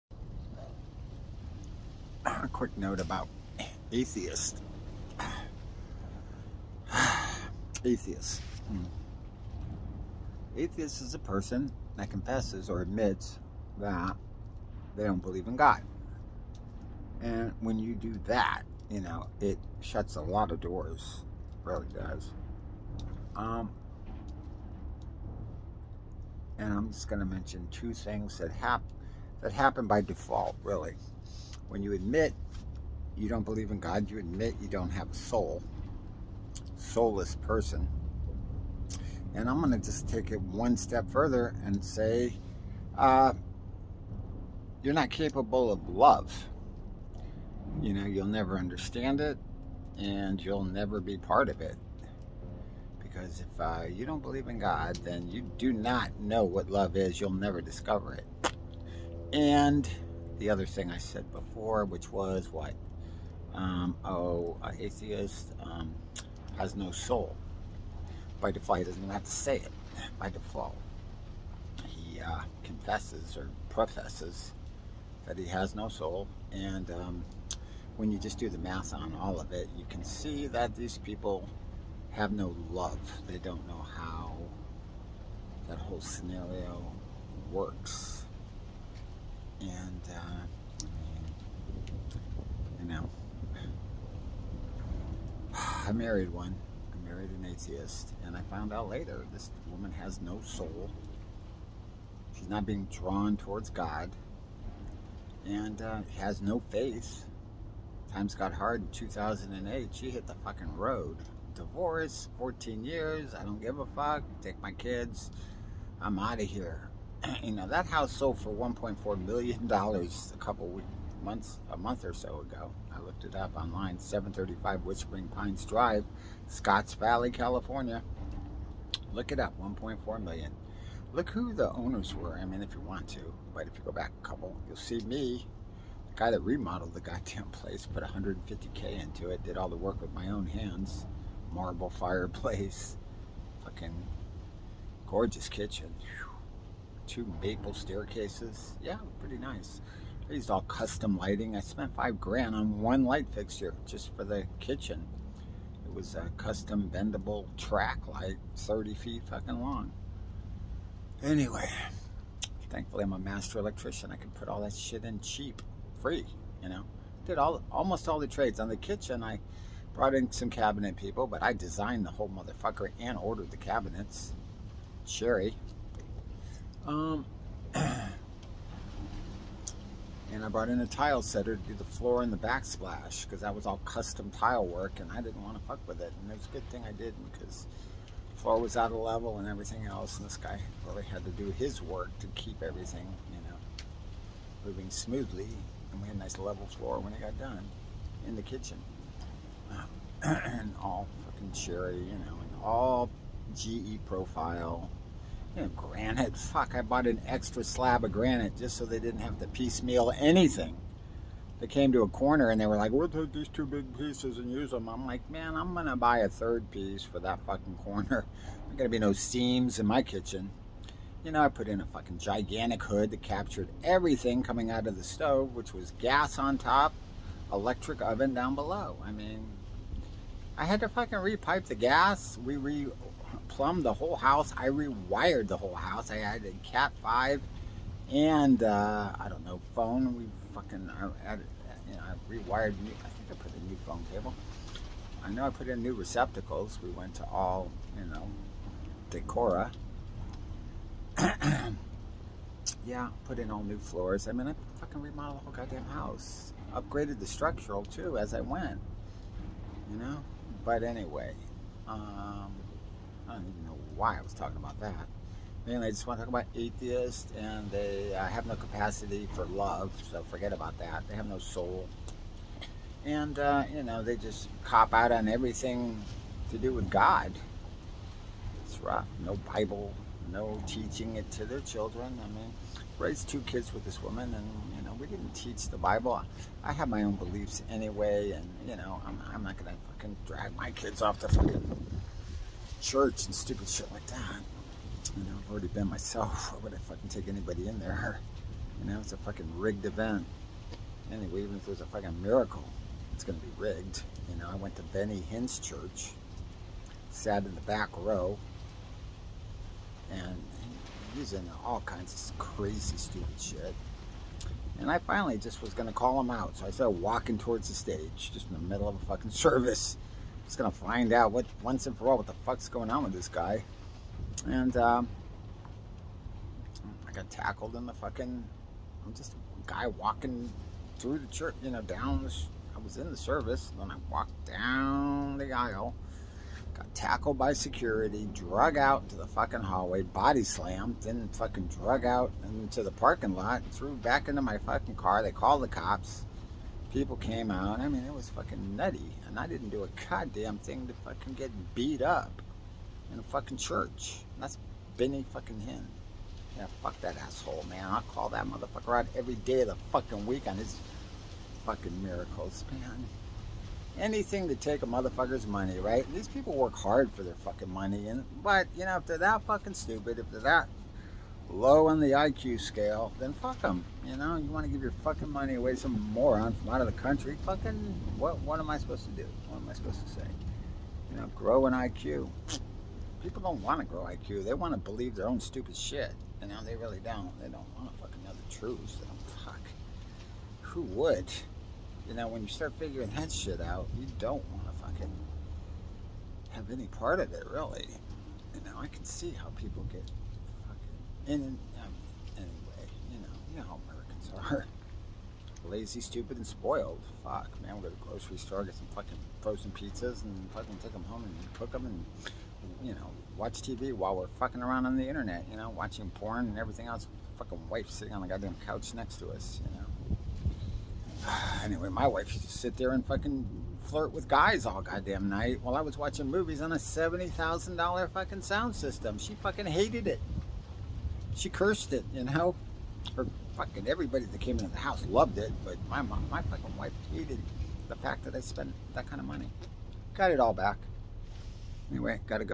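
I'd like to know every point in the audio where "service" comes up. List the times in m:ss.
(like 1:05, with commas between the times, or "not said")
5:19, 5:33.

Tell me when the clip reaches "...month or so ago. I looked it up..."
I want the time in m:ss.
2:01.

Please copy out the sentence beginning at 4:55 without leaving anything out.
You know, I've already been myself.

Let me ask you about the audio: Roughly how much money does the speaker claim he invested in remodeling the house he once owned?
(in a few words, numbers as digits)
150K.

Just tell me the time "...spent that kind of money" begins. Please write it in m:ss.
7:18.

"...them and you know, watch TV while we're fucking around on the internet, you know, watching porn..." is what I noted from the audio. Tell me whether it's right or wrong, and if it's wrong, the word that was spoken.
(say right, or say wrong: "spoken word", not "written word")
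right.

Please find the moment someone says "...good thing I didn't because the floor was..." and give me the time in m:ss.
3:06.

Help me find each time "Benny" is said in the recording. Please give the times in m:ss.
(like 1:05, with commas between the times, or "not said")
5:04, 5:54.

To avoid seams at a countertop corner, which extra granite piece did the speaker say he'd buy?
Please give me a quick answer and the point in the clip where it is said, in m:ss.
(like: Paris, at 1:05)
third piece, at 3:36.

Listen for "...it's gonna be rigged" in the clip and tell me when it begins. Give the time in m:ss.
5:03.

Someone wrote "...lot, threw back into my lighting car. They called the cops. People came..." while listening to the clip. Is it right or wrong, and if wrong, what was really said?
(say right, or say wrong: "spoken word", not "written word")
wrong: "fucking", not "lighting".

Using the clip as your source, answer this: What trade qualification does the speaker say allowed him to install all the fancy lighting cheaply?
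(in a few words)
master electrician.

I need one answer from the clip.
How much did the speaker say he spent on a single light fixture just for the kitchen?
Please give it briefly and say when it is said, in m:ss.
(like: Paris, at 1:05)
five grand, at 2:31.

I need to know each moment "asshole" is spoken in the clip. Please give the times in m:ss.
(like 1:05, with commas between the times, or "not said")
5:57.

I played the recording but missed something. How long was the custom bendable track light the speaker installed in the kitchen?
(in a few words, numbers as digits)
30 feet.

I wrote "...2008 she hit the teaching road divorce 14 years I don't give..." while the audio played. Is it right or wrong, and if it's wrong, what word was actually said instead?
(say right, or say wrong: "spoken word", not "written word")
wrong: "fucking", not "teaching".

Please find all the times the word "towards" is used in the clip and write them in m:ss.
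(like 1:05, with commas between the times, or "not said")
1:43, 5:17.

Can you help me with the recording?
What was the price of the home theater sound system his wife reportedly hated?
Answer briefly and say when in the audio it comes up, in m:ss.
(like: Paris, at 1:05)
$70,000, at 7:06.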